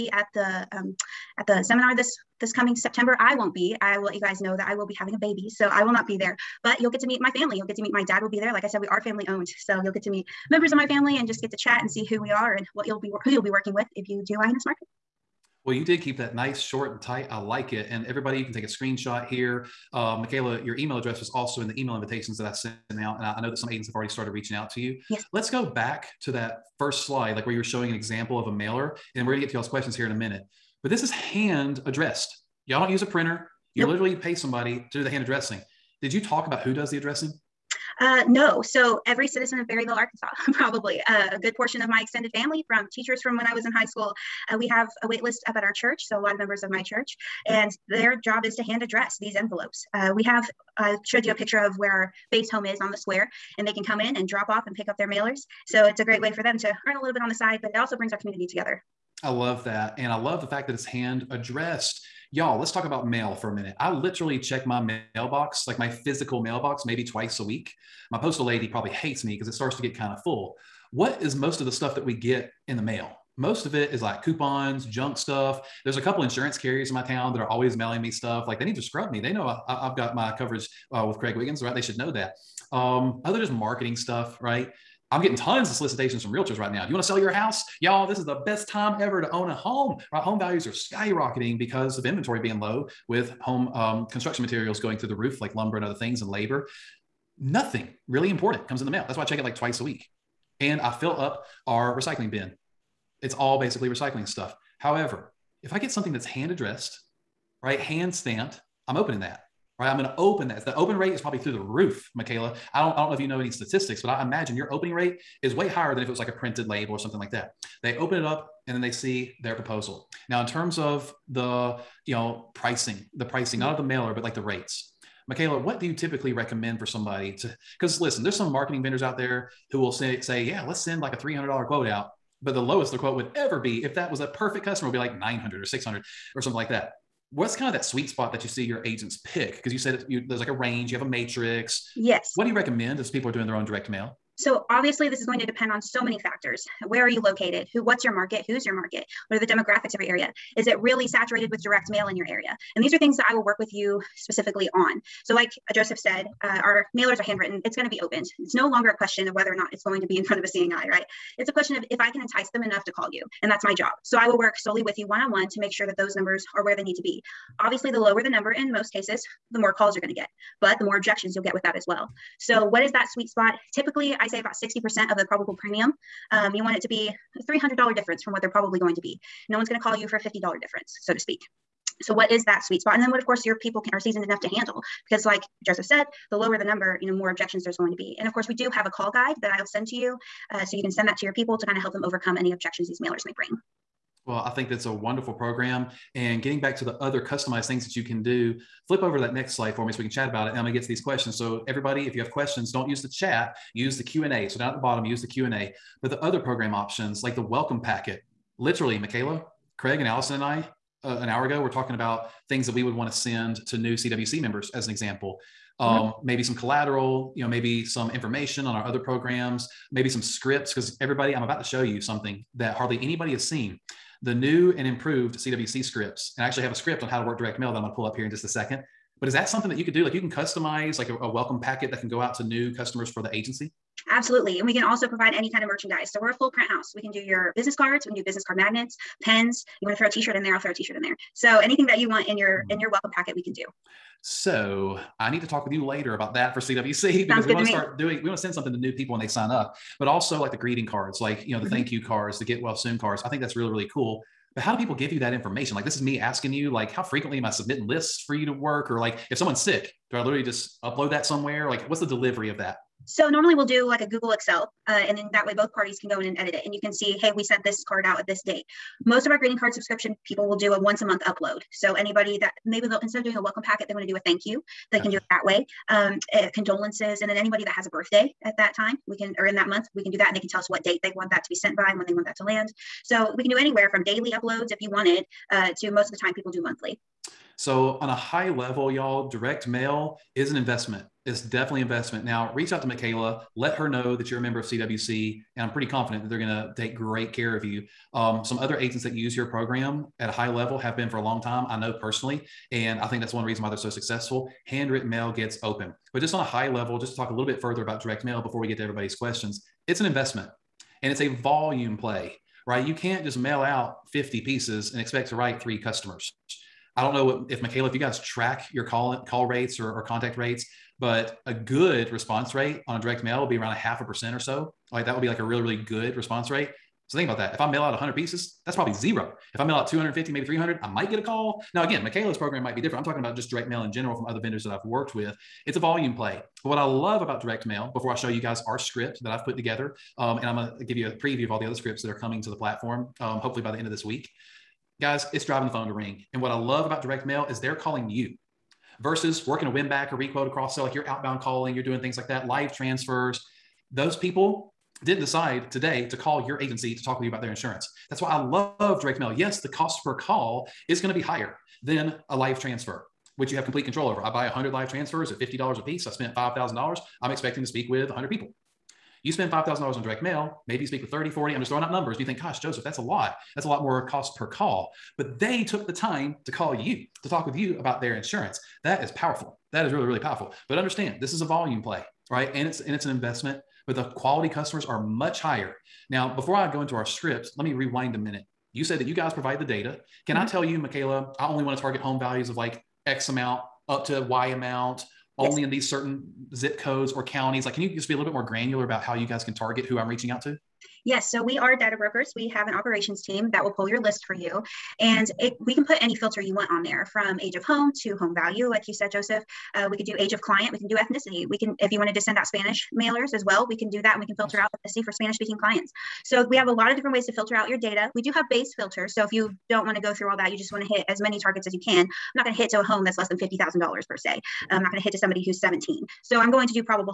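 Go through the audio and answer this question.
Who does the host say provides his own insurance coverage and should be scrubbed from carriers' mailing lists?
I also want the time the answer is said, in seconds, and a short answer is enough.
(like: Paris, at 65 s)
Craig Wiggins, at 81 s.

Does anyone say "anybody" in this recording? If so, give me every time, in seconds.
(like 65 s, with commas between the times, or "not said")
222 s, 271 s, 277 s.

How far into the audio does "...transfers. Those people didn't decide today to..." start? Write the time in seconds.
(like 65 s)
352 s.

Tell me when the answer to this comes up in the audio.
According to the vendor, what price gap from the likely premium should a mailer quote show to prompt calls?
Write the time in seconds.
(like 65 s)
177 s.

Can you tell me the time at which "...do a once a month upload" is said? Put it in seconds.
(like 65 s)
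270 s.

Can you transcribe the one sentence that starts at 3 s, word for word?
I will let you guys know that I will be having a baby, so I will not be there.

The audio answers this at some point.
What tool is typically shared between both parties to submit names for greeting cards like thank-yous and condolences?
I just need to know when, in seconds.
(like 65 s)
264 s.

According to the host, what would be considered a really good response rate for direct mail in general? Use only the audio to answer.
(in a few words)
half a percent.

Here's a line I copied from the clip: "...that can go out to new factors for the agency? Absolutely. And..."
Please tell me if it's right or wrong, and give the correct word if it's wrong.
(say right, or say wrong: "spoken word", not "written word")
wrong: "customers", not "factors".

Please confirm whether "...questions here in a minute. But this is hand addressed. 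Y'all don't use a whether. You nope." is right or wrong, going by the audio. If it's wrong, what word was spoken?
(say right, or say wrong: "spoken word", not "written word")
wrong: "printer", not "whether".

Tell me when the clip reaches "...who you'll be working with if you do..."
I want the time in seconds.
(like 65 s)
13 s.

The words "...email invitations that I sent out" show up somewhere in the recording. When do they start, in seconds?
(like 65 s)
21 s.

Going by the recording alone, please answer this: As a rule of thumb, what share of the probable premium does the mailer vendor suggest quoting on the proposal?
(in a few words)
60%.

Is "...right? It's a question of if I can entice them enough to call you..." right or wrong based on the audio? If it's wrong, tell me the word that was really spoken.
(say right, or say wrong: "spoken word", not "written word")
right.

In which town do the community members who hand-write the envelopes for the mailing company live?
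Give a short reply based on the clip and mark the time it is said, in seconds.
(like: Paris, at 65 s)
Berryville, Arkansas, at 39 s.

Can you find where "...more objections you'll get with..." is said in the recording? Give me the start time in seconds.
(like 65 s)
170 s.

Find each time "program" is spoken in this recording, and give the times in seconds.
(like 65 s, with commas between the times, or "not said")
195 s, 206 s, 218 s, 299 s, 332 s.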